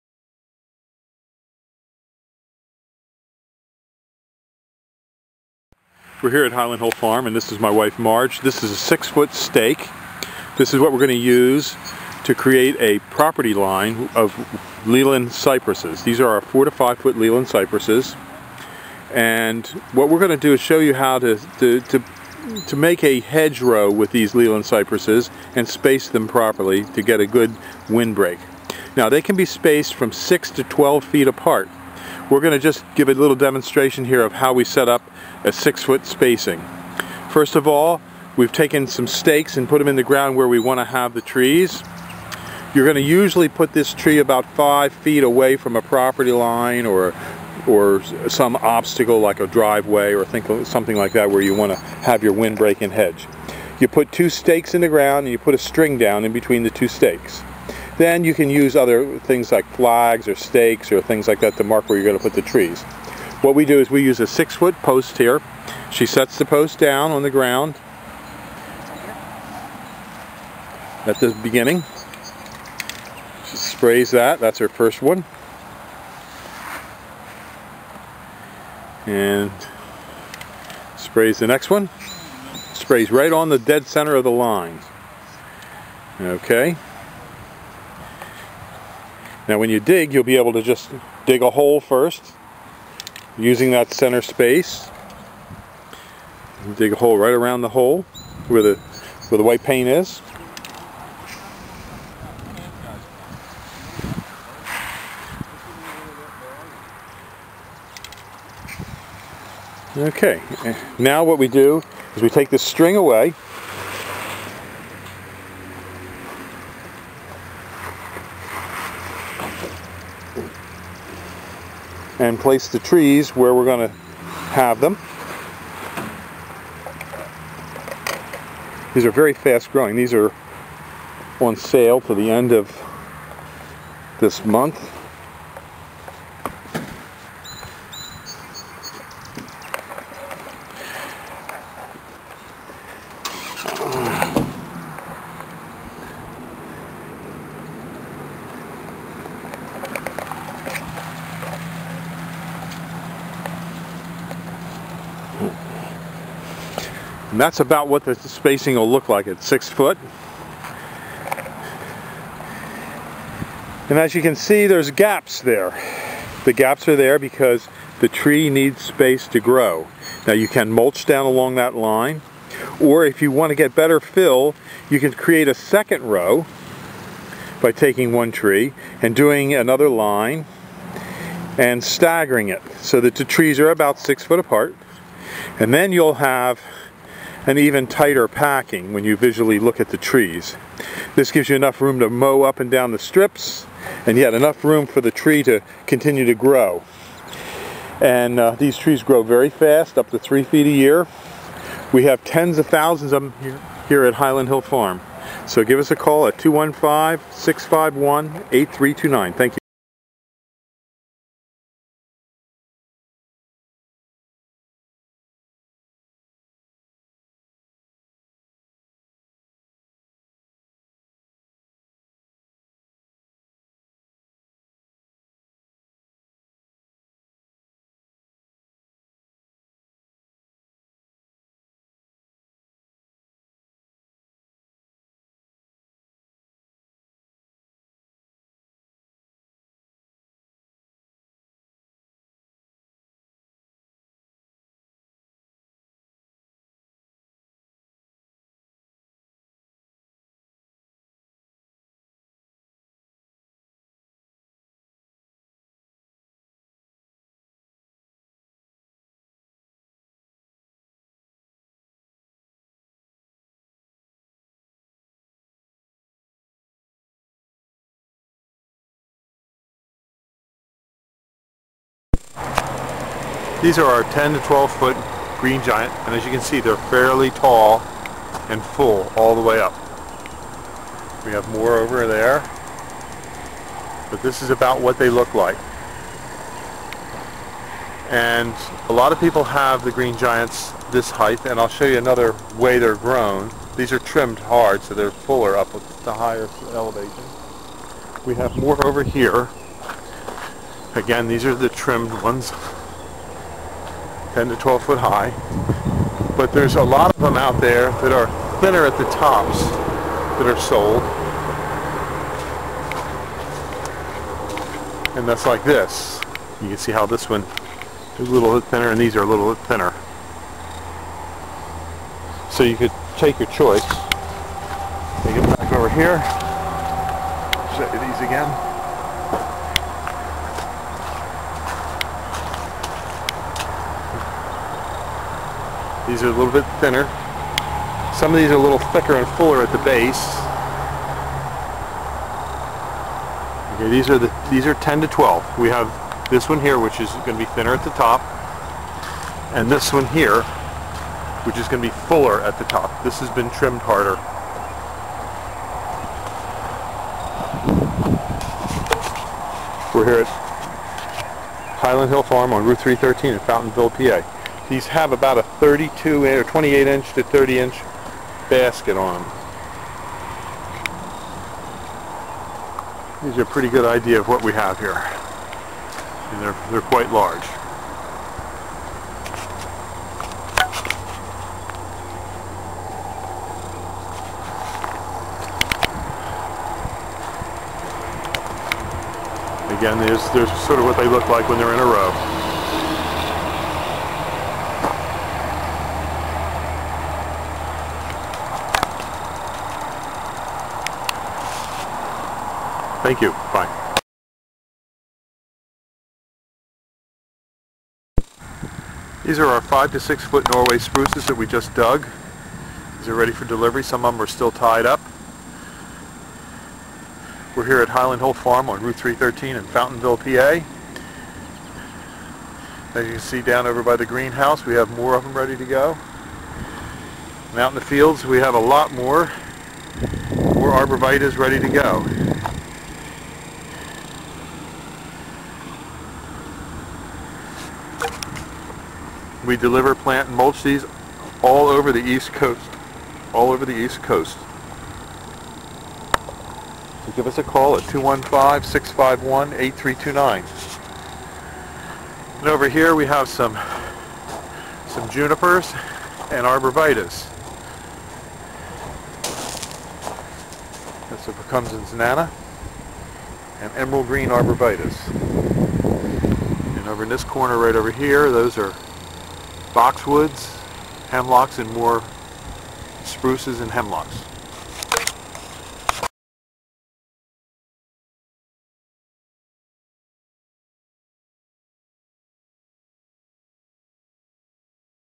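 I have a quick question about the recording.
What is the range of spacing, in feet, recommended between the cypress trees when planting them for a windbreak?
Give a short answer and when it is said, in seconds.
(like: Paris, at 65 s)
6 to 12 feet, at 30 s.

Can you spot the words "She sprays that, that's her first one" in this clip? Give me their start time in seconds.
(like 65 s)
73 s.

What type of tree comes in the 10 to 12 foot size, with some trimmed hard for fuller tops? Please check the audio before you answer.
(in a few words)
Green Giant.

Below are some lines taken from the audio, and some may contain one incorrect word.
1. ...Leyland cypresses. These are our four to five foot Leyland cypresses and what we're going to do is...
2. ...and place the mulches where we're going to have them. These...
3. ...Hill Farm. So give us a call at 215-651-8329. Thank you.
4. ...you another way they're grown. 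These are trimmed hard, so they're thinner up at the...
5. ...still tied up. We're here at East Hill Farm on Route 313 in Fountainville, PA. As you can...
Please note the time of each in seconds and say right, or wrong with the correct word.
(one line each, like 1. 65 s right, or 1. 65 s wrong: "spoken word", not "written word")
1. 14 s right
2. 122 s wrong: "trees", not "mulches"
3. 204 s right
4. 291 s wrong: "fuller", not "thinner"
5. 414 s wrong: "Highland", not "East".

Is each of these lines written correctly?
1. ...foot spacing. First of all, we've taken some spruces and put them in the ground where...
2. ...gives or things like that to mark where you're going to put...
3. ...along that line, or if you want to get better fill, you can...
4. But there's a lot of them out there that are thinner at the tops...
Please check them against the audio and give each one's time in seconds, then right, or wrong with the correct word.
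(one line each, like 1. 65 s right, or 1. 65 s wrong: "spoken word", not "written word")
1. 35 s wrong: "stakes", not "spruces"
2. 60 s wrong: "stakes", not "gives"
3. 171 s right
4. 306 s right.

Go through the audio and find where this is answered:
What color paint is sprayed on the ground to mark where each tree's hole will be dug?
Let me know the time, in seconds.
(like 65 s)
99 s.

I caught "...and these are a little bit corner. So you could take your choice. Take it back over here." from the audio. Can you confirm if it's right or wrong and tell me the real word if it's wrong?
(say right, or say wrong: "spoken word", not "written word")
wrong: "thinner", not "corner".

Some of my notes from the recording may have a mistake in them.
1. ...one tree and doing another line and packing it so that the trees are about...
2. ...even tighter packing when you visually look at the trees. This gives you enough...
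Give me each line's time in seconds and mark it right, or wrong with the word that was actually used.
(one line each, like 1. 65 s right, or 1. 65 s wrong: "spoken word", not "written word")
1. 178 s wrong: "staggering", not "packing"
2. 187 s right.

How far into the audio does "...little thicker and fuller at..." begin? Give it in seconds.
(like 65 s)
338 s.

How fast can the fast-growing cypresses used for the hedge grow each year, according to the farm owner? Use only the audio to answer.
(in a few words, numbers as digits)
3 feet a year.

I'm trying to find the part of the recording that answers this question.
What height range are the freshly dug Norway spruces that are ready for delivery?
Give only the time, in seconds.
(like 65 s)
409 s.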